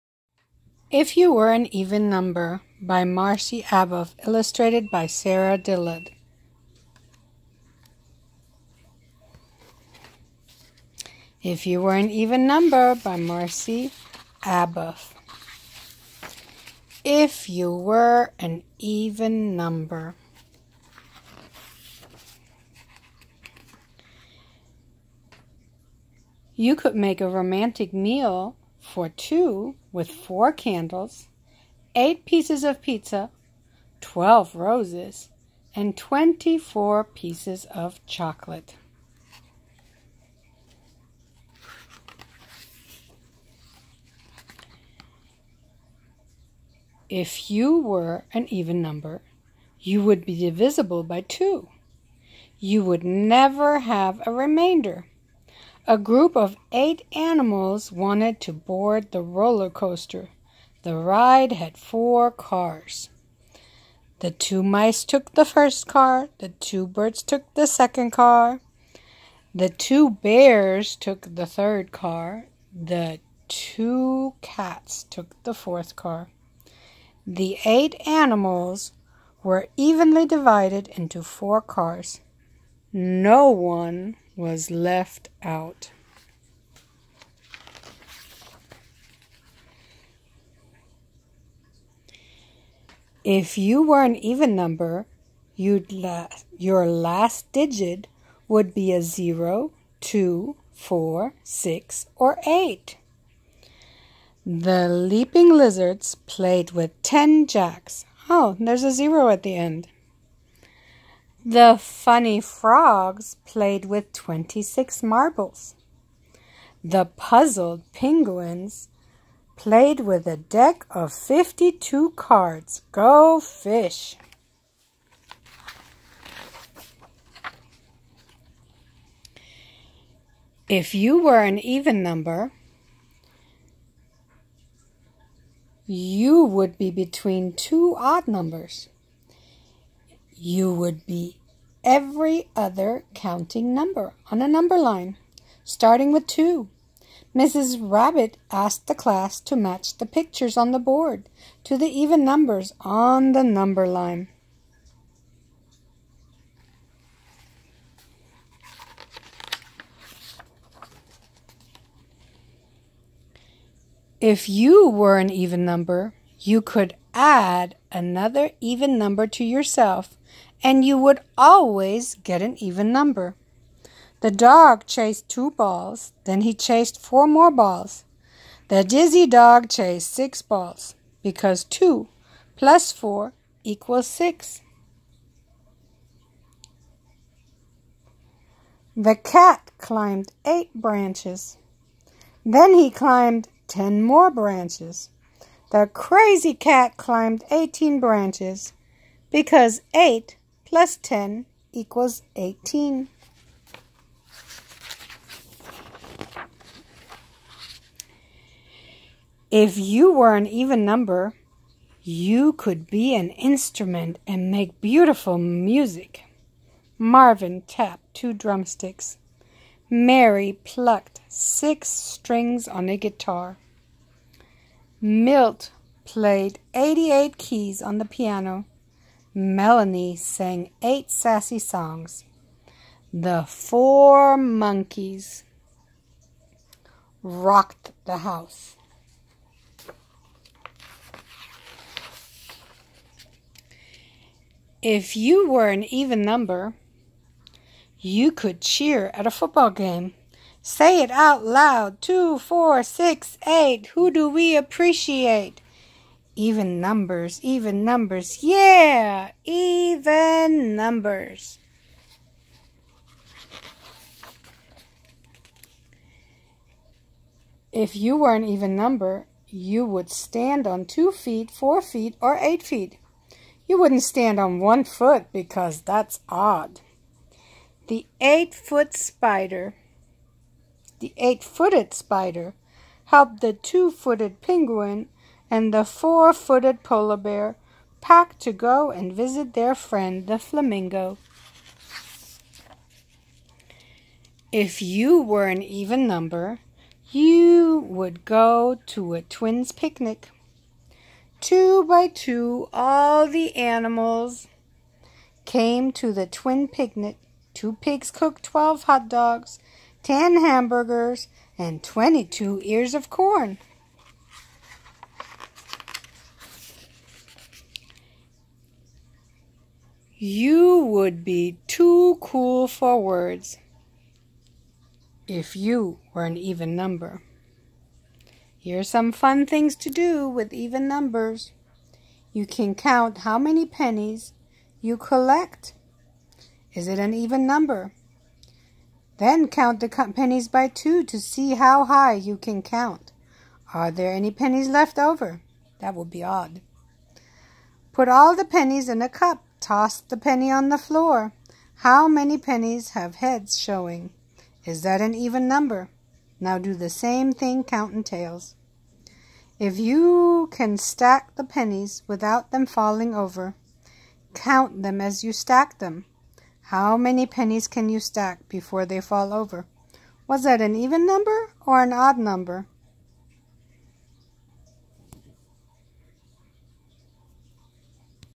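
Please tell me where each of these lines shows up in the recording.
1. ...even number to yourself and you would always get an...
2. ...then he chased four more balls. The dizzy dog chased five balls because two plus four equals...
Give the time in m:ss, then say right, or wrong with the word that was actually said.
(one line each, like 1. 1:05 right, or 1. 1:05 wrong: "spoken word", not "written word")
1. 2:48 right
2. 2:56 wrong: "six", not "five".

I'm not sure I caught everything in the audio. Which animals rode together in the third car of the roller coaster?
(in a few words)
bears.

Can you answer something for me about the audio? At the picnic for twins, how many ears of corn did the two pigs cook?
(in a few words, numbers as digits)
22.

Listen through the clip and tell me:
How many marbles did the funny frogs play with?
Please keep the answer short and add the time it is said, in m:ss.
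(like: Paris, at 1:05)
26, at 1:54.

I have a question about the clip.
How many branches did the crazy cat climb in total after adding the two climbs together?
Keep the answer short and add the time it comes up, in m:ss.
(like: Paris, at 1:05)
18, at 3:17.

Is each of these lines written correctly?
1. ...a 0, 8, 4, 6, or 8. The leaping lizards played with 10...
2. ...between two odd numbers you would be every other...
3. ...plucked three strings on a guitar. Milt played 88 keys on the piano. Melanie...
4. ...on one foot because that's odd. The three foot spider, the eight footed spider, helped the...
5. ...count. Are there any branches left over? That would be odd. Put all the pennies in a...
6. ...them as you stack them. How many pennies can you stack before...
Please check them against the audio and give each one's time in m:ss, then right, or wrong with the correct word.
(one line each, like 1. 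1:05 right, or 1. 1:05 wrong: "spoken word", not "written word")
1. 1:38 wrong: "2", not "8"
2. 2:16 right
3. 3:40 wrong: "six", not "three"
4. 4:34 wrong: "eight", not "three"
5. 5:42 wrong: "pennies", not "branches"
6. 6:04 right.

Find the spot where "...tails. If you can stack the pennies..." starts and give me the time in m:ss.
5:58.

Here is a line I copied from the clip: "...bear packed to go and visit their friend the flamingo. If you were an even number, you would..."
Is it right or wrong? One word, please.
right.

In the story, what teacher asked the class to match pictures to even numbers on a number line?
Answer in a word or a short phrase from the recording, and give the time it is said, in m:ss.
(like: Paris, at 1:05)
Mrs. Rabbit, at 2:27.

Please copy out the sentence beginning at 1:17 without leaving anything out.
The eight animals were evenly divided into four cars.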